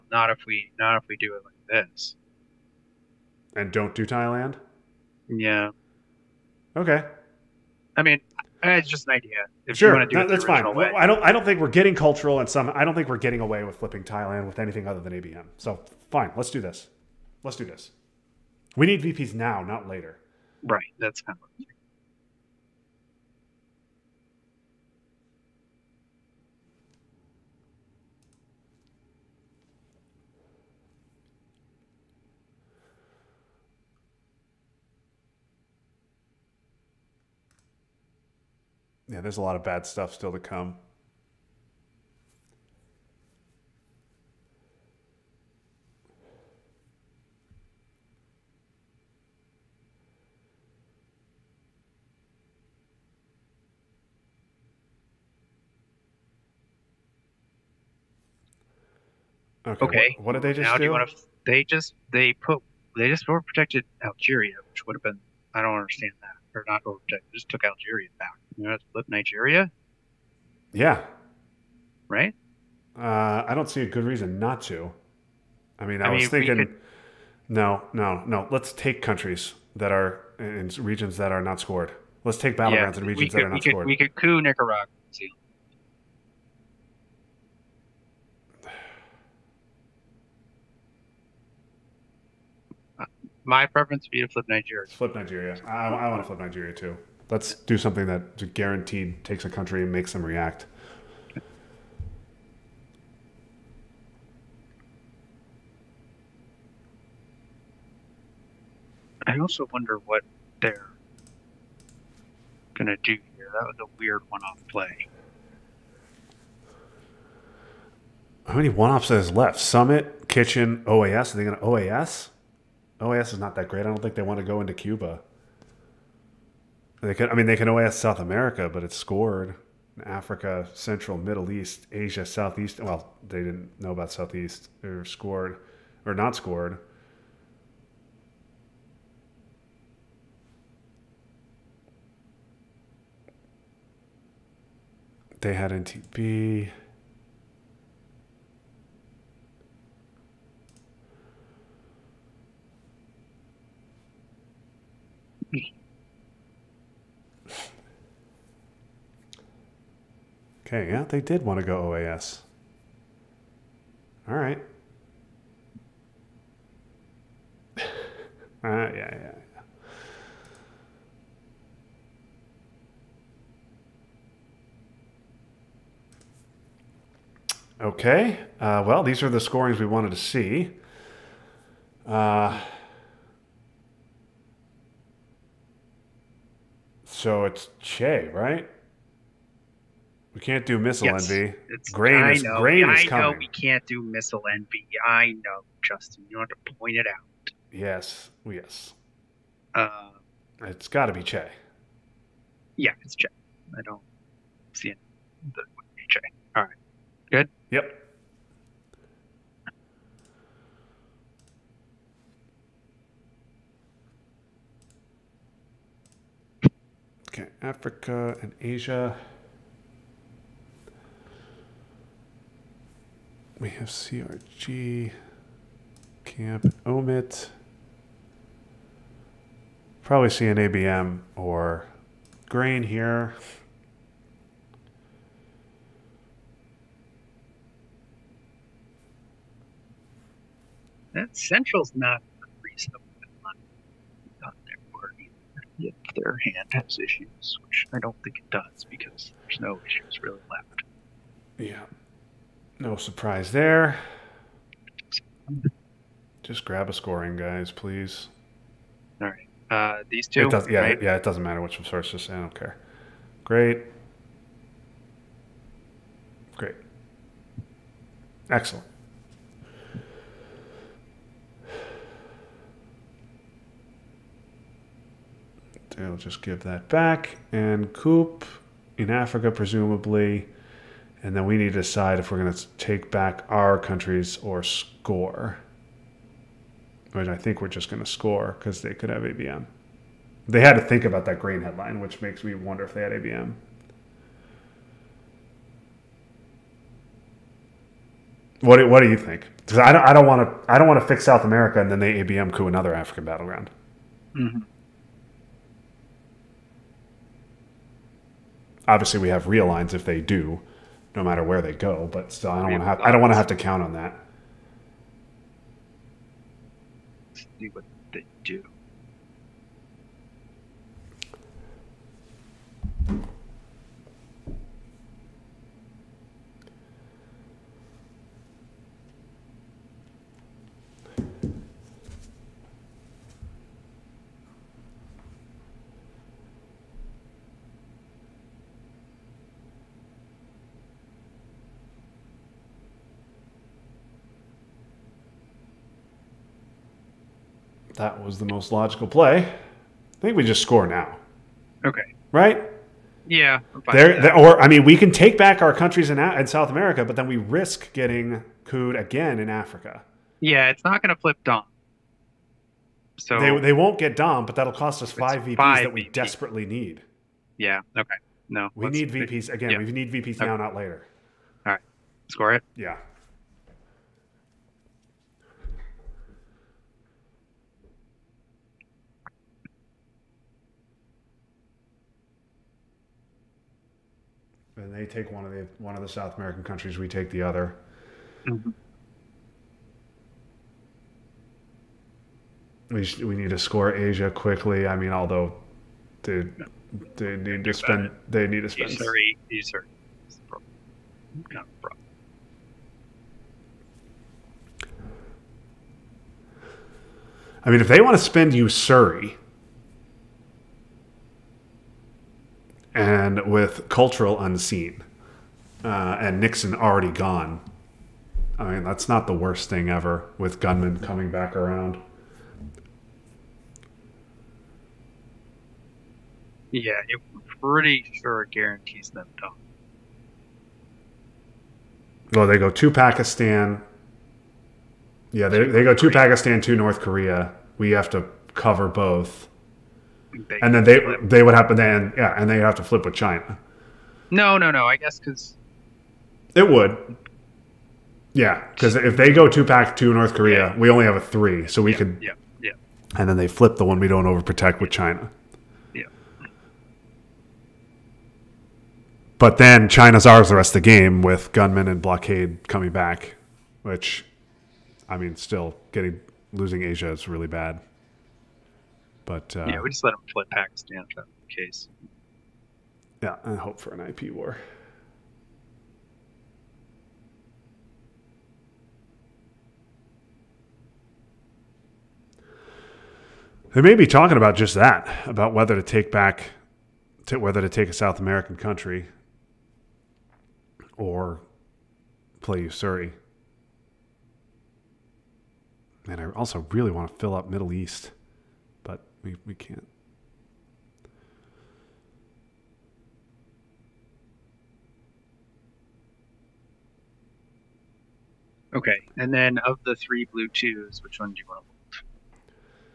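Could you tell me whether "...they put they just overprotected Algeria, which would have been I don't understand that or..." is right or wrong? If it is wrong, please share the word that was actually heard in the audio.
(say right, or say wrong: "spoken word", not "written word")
right.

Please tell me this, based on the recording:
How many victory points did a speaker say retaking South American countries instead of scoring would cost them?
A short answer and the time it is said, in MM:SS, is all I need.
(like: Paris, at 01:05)
5, at 06:05.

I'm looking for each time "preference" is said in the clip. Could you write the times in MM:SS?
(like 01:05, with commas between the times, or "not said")
01:33.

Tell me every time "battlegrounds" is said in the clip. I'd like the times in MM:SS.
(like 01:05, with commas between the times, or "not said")
01:22, 05:03.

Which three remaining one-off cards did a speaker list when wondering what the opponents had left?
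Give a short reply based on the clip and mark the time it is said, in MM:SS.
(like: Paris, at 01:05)
Summit, Kitchen, OAS, at 01:59.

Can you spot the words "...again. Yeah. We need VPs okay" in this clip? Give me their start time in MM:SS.
06:09.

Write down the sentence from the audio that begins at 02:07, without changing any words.
They could, I mean, they can OAS South America, but it's scored Africa, Central, Middle East, Asia, Southeast.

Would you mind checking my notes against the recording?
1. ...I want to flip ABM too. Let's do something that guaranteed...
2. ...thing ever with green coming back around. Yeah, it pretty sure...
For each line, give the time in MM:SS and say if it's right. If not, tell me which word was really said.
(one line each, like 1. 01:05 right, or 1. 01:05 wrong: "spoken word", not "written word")
1. 01:35 wrong: "Nigeria", not "ABM"
2. 06:59 wrong: "gunmen", not "green".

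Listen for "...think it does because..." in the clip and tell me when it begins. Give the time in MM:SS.
04:08.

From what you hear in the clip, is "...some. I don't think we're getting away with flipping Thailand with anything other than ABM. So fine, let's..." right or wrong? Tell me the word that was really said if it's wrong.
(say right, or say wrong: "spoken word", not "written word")
right.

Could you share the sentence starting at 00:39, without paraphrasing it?
yeah, there's a lot of bad stuff still to come.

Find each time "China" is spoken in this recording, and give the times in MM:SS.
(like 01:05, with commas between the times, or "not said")
07:23, 07:34, 07:39.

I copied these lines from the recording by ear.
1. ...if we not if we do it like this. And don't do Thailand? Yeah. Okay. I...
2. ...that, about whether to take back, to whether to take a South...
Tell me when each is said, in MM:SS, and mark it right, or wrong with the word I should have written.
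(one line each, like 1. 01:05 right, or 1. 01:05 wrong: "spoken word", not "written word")
1. 00:00 right
2. 08:04 right.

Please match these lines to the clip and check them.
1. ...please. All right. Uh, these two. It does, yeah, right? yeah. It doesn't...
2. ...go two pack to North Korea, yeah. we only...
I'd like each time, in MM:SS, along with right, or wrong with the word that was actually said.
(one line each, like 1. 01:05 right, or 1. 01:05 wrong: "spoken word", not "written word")
1. 04:17 right
2. 07:29 right.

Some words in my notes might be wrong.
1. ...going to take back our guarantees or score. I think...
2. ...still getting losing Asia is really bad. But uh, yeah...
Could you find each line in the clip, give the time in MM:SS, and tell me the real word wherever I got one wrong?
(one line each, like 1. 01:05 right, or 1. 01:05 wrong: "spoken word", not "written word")
1. 04:42 wrong: "countries", not "guarantees"
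2. 07:45 right.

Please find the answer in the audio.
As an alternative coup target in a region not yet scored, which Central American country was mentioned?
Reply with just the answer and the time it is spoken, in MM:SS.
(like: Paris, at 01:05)
Nicaragua, at 01:24.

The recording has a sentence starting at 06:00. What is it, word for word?
Yeah, it's not going to flip Dom.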